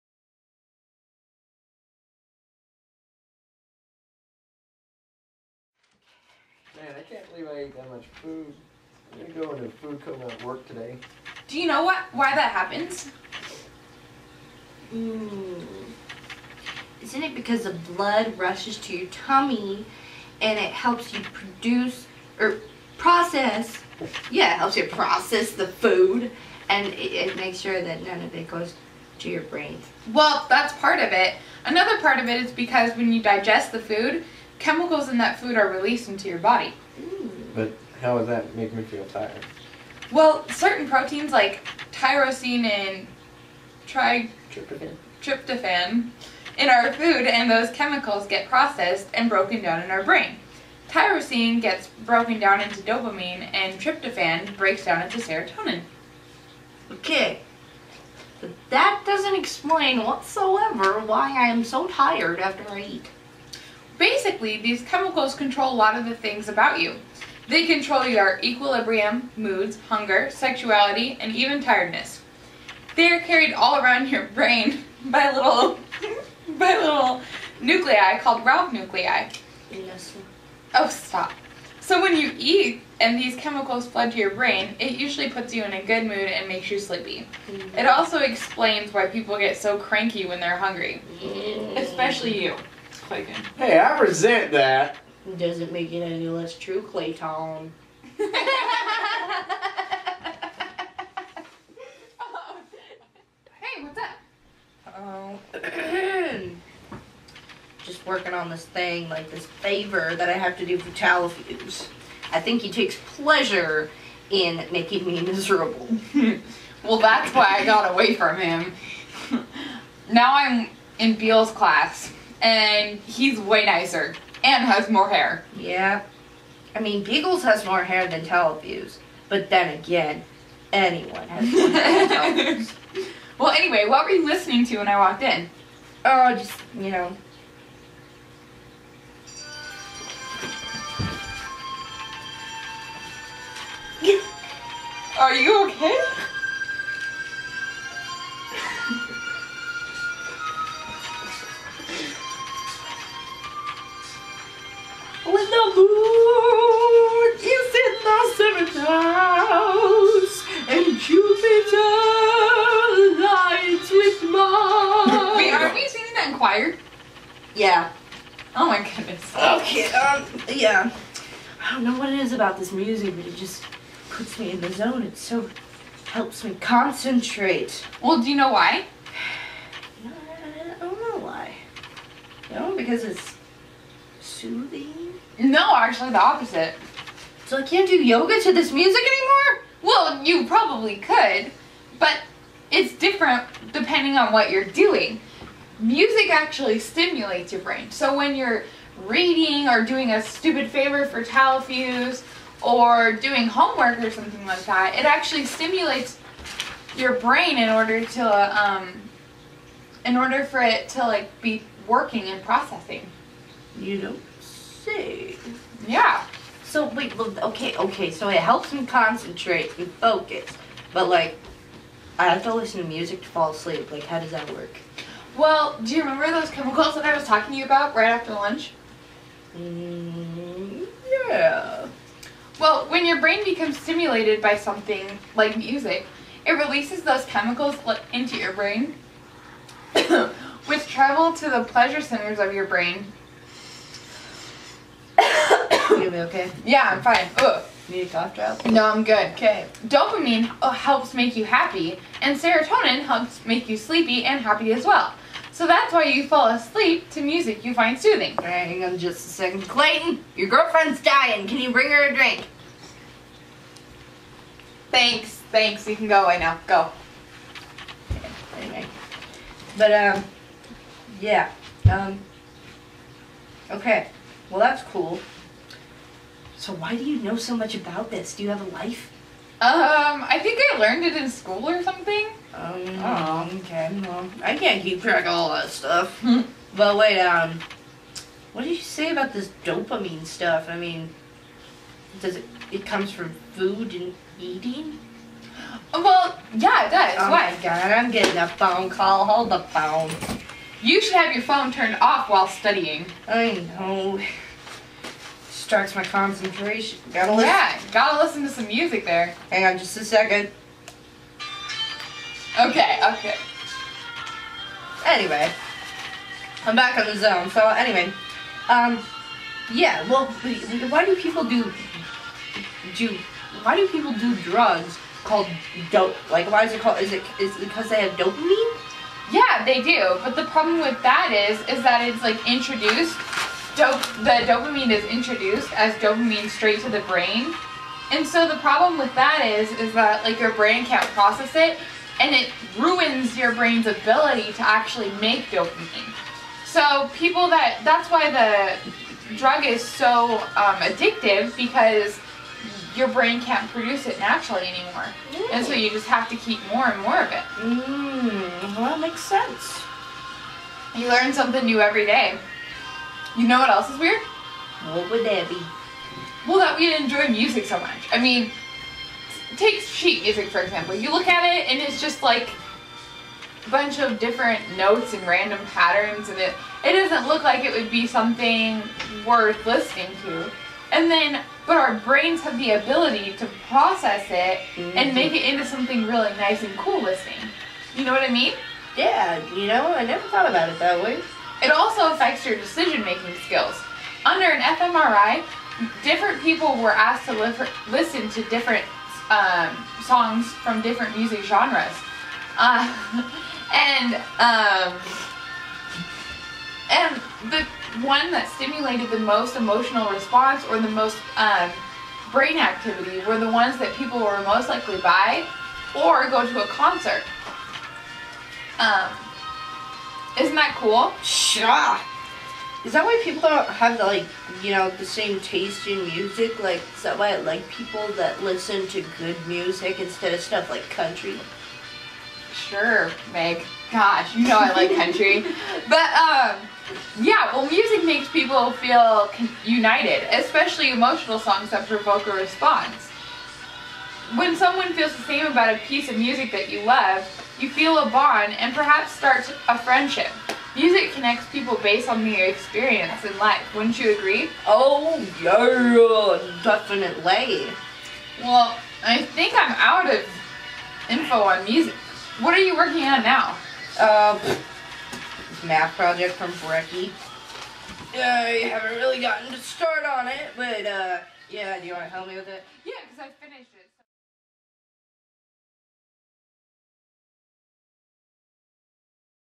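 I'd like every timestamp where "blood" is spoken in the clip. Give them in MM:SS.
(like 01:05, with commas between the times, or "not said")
00:17.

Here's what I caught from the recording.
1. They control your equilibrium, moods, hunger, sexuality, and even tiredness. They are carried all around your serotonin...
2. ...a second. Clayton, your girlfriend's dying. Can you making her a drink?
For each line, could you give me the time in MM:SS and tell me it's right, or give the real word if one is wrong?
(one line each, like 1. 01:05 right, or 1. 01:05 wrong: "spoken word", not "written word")
1. 01:07 wrong: "brain", not "serotonin"
2. 04:19 wrong: "bring", not "making".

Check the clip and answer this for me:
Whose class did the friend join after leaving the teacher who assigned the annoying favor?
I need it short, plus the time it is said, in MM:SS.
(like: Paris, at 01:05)
Beale's, at 02:01.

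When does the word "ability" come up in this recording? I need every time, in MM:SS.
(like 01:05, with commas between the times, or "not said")
05:43, 06:22.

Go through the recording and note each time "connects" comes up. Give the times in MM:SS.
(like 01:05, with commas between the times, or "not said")
07:31.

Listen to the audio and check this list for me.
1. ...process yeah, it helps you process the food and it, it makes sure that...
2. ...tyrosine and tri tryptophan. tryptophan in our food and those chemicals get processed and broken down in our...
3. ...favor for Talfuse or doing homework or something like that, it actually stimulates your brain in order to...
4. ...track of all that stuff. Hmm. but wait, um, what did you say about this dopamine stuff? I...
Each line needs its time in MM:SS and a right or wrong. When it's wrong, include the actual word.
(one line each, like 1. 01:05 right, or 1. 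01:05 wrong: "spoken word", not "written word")
1. 00:22 right
2. 00:41 right
3. 03:20 right
4. 04:45 right.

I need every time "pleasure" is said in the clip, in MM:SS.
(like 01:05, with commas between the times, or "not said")
01:53, 04:01.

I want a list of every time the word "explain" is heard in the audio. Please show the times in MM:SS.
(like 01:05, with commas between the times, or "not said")
00:59, 01:28.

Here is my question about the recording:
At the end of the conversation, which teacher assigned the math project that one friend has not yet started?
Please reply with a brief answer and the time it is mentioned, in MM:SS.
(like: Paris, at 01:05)
Brecky, at 07:46.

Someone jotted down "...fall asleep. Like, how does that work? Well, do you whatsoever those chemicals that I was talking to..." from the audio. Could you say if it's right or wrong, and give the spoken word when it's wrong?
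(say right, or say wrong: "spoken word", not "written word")
wrong: "remember", not "whatsoever".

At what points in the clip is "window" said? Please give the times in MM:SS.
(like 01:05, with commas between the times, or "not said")
not said.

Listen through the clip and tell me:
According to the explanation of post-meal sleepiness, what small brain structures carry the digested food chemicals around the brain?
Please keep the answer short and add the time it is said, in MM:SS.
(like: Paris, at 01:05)
raphe nuclei, at 01:18.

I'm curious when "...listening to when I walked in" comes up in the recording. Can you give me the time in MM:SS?
02:14.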